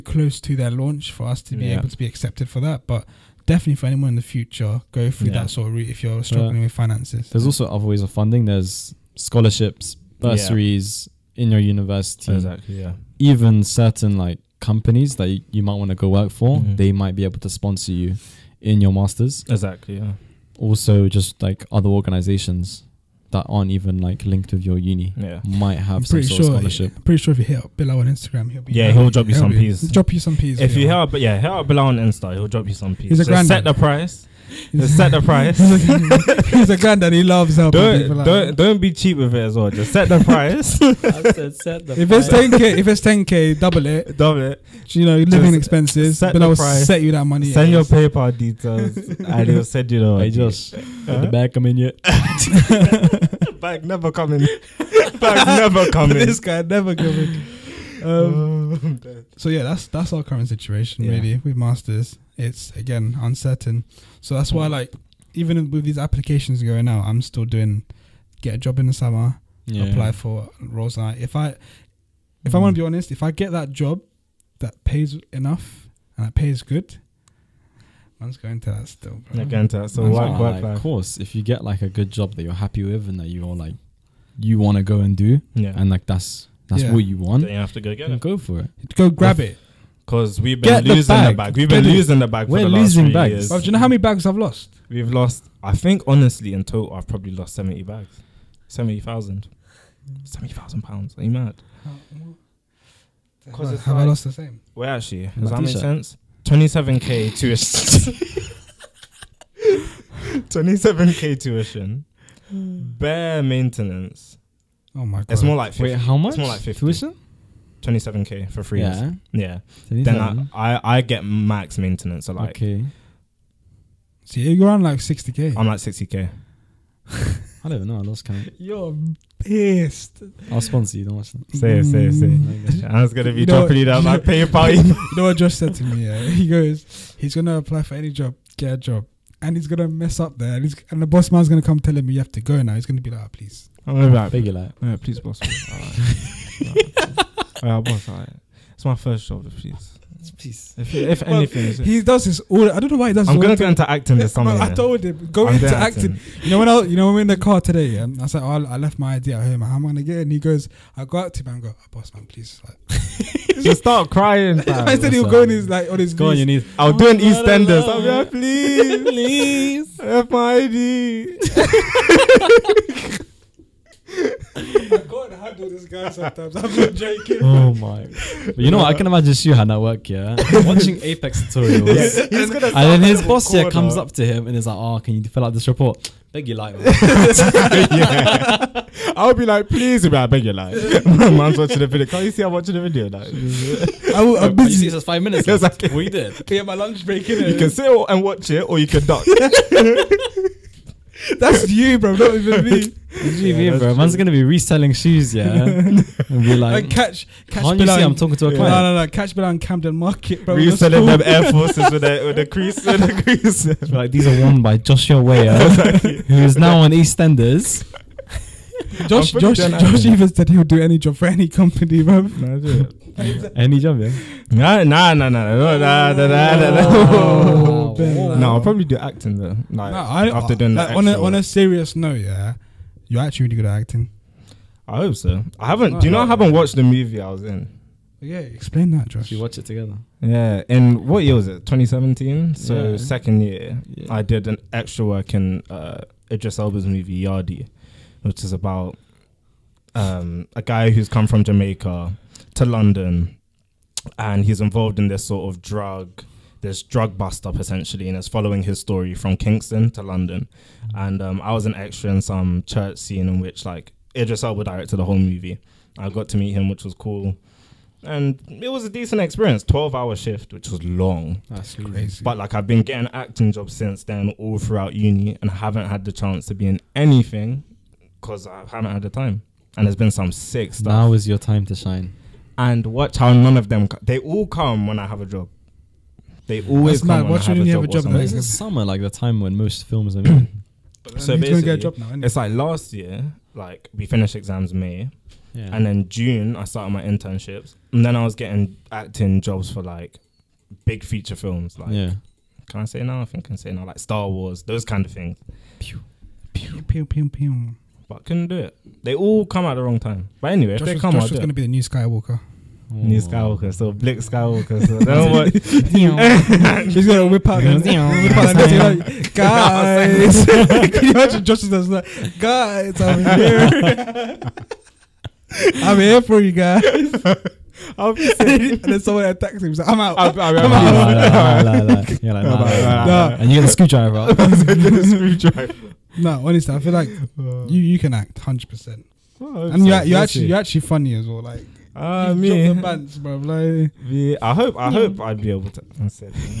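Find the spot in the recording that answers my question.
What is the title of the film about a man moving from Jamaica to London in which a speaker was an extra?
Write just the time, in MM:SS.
04:07.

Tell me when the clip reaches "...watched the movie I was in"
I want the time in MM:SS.
03:56.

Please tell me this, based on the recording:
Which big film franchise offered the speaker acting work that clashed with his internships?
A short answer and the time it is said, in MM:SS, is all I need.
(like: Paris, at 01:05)
Star Wars, at 05:03.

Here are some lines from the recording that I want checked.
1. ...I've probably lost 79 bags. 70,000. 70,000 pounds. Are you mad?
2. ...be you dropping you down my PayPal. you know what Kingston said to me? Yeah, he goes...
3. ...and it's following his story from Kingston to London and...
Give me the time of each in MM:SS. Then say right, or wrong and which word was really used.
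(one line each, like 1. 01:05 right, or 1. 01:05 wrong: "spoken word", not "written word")
1. 01:36 wrong: "70", not "79"
2. 02:13 wrong: "Josh", not "Kingston"
3. 04:18 right.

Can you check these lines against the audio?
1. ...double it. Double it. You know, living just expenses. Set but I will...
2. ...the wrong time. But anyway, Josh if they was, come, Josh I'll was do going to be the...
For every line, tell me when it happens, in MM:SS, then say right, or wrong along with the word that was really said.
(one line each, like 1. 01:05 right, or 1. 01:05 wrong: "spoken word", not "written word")
1. 00:43 right
2. 05:09 right.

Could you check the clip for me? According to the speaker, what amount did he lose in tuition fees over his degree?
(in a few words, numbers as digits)
27k.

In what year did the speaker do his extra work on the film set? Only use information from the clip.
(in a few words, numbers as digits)
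2017.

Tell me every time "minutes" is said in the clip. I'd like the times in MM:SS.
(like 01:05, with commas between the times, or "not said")
03:15.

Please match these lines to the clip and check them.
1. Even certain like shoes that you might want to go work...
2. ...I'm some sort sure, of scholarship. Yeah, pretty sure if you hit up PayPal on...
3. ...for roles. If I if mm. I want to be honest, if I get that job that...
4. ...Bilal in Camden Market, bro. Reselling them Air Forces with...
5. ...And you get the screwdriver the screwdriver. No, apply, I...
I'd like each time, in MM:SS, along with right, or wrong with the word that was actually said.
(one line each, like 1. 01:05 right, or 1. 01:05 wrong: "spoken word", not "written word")
1. 00:13 wrong: "companies", not "shoes"
2. 00:25 wrong: "Bilal", not "PayPal"
3. 01:10 right
4. 03:29 right
5. 05:33 wrong: "honestly", not "apply".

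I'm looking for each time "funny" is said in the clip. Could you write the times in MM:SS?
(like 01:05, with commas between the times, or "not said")
05:40.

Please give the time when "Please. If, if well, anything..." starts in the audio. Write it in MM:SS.
02:30.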